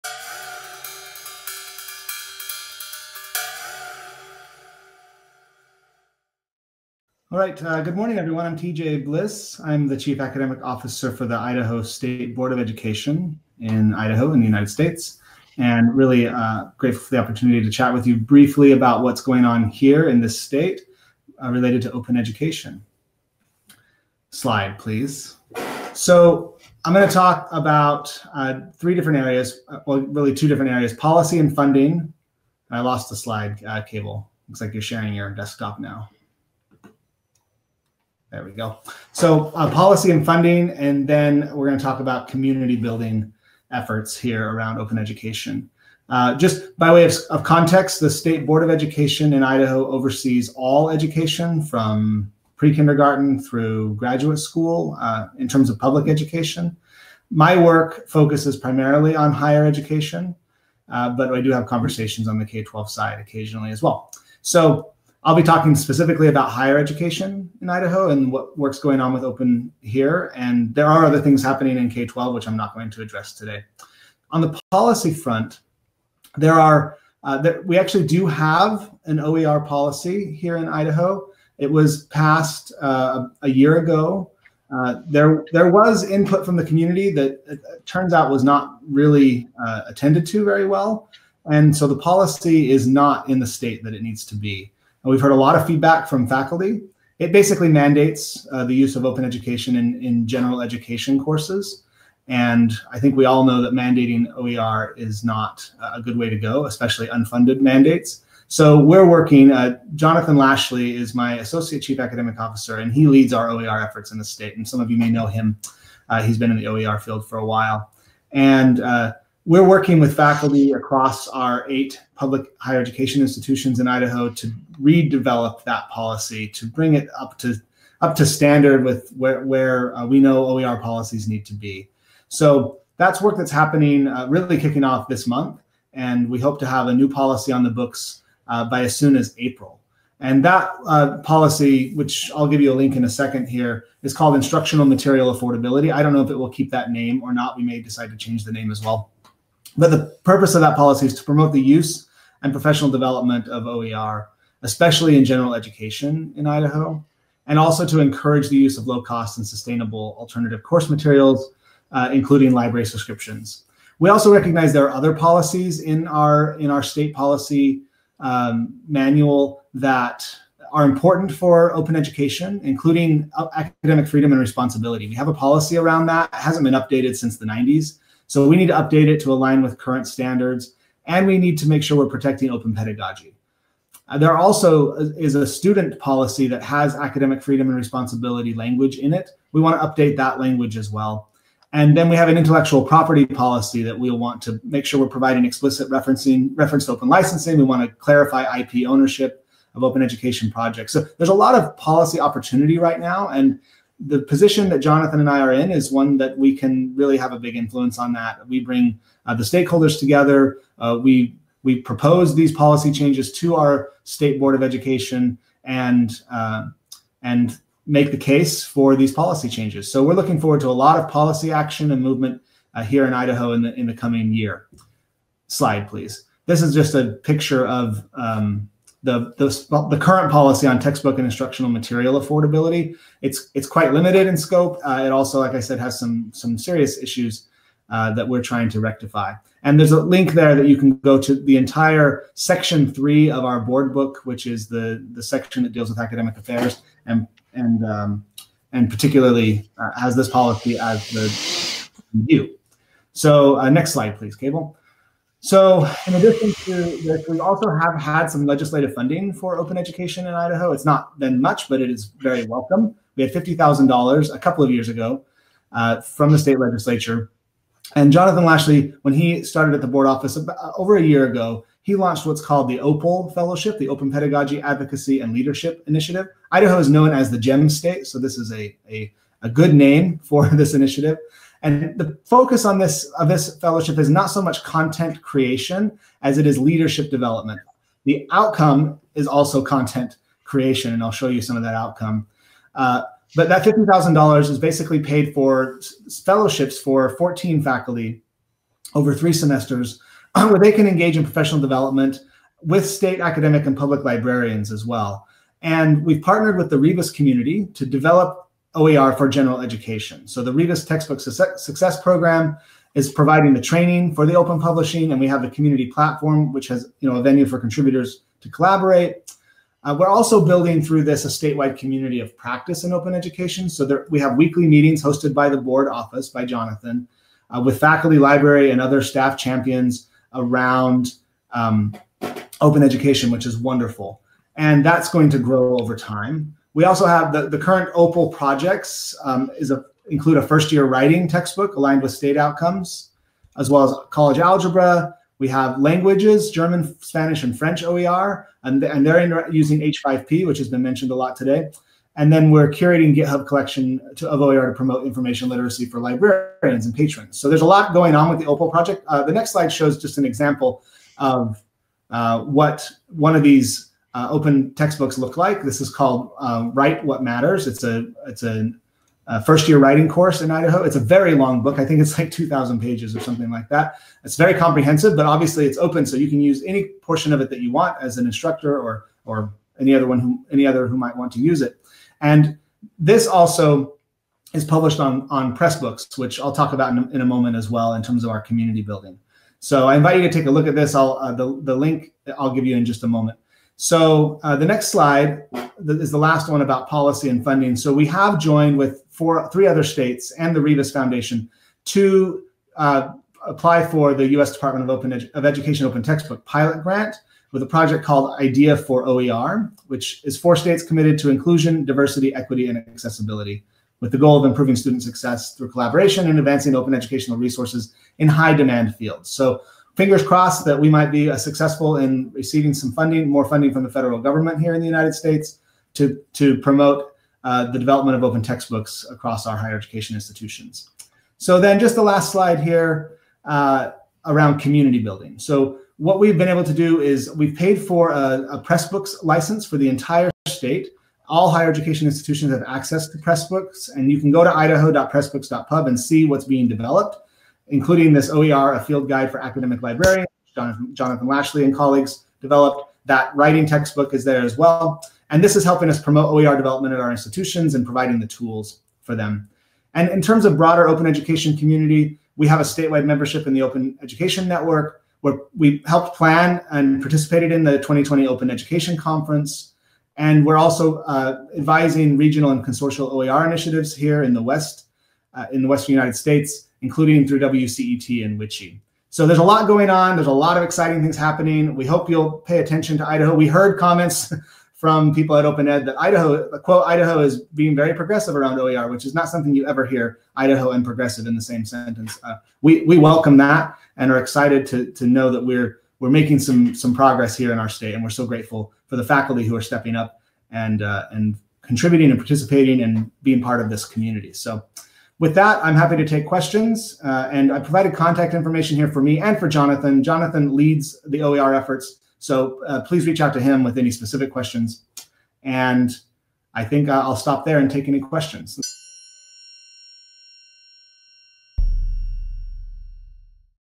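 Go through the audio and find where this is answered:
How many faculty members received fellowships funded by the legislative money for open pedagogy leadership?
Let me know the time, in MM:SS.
04:57.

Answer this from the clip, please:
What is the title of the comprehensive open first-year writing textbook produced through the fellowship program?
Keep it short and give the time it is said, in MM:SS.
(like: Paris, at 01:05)
Write What Matters, at 06:06.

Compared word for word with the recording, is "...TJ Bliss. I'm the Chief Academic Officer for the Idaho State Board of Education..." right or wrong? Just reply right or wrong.
right.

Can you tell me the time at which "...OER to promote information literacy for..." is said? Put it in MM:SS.
05:54.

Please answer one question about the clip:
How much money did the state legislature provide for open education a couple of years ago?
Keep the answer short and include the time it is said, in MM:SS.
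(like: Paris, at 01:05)
$50,000, at 04:23.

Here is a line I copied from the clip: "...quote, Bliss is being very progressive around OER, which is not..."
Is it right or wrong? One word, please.
wrong.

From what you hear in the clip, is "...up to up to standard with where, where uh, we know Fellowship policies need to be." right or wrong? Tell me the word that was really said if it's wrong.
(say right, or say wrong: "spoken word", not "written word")
wrong: "OER", not "Fellowship".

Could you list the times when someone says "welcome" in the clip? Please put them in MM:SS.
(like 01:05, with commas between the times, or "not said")
04:22, 08:12.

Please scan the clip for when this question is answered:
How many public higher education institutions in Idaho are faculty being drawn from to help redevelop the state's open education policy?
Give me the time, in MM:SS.
02:01.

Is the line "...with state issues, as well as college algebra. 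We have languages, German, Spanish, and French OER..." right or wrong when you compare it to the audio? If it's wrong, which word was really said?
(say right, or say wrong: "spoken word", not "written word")
wrong: "outcomes", not "issues".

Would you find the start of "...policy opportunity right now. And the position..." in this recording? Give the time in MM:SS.
03:21.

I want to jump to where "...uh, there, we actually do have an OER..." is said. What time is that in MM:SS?
01:17.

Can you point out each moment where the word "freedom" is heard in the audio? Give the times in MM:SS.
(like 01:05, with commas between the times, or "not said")
02:54, 03:07.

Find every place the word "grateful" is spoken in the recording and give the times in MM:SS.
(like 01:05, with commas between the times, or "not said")
00:16, 08:18.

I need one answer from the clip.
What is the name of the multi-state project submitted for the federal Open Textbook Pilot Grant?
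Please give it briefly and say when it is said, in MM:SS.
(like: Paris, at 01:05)
IDEA for OER, at 06:48.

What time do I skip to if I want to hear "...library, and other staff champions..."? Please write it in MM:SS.
05:28.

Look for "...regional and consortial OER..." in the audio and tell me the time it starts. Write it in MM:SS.
07:52.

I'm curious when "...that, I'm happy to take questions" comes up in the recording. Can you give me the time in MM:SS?
08:25.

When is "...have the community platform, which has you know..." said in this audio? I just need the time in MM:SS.
05:15.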